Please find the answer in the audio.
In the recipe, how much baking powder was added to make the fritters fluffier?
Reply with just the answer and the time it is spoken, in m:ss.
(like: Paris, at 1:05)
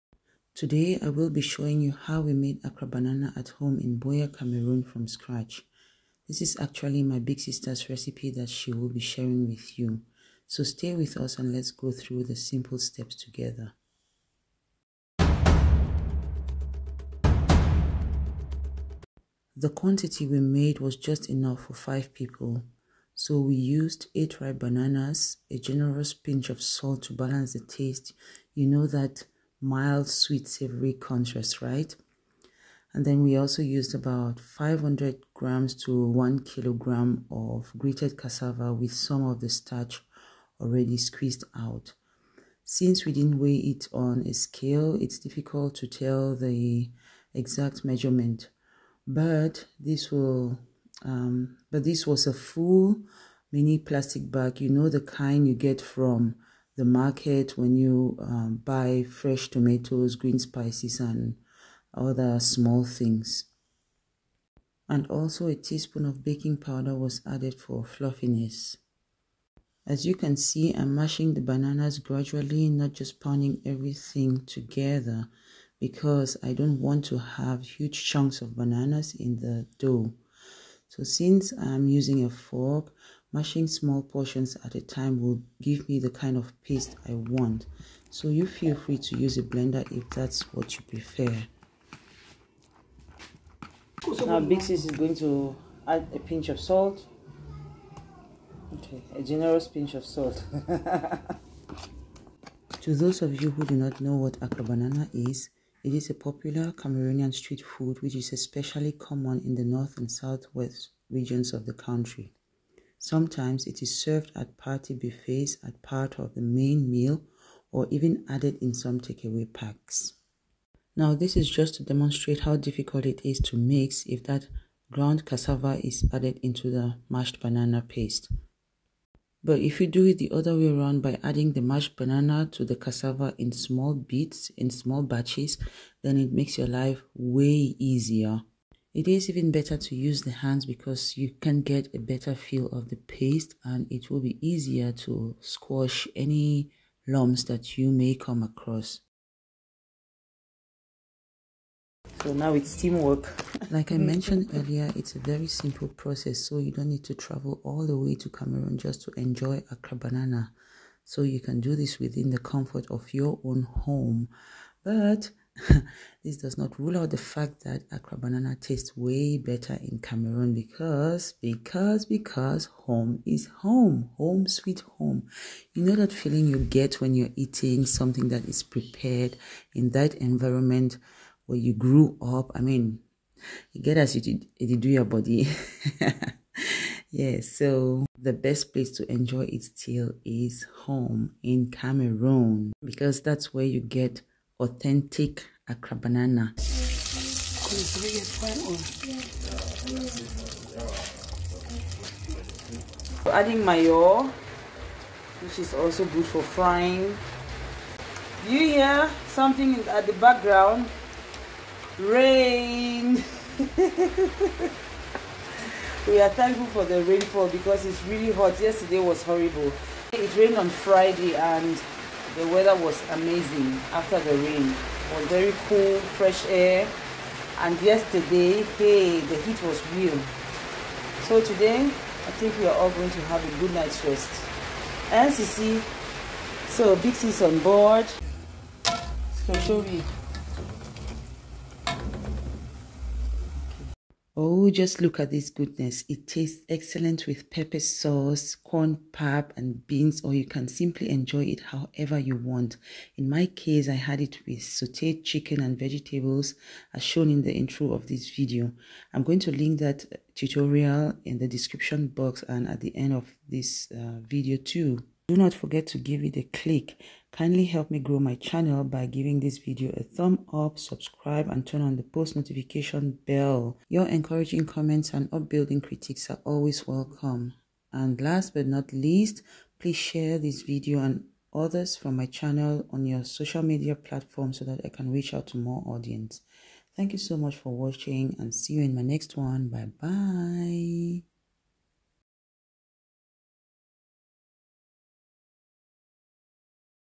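a teaspoon, at 1:05.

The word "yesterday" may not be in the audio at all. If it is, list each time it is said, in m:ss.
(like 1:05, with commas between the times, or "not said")
3:38, 3:47.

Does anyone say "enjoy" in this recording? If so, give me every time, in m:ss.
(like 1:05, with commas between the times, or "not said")
2:39, 3:09, 4:11.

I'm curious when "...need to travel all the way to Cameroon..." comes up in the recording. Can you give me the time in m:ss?
2:36.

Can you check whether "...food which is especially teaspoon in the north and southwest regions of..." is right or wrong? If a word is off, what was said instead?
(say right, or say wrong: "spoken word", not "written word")
wrong: "common", not "teaspoon".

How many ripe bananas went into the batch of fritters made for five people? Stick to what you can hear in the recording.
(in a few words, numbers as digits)
8.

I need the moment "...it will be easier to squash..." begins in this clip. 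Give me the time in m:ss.
2:23.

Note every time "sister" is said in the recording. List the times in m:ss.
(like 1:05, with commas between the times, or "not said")
0:07.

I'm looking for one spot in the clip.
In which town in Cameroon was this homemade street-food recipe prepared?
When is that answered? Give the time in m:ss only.
0:03.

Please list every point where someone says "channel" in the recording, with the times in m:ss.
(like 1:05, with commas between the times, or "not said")
4:28, 4:42.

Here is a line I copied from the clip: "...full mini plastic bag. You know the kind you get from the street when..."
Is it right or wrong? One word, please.
wrong.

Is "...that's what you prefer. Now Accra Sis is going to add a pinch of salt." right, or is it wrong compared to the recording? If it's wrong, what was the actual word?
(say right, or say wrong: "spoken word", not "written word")
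wrong: "Big", not "Accra".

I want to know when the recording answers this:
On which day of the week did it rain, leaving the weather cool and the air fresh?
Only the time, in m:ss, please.
3:40.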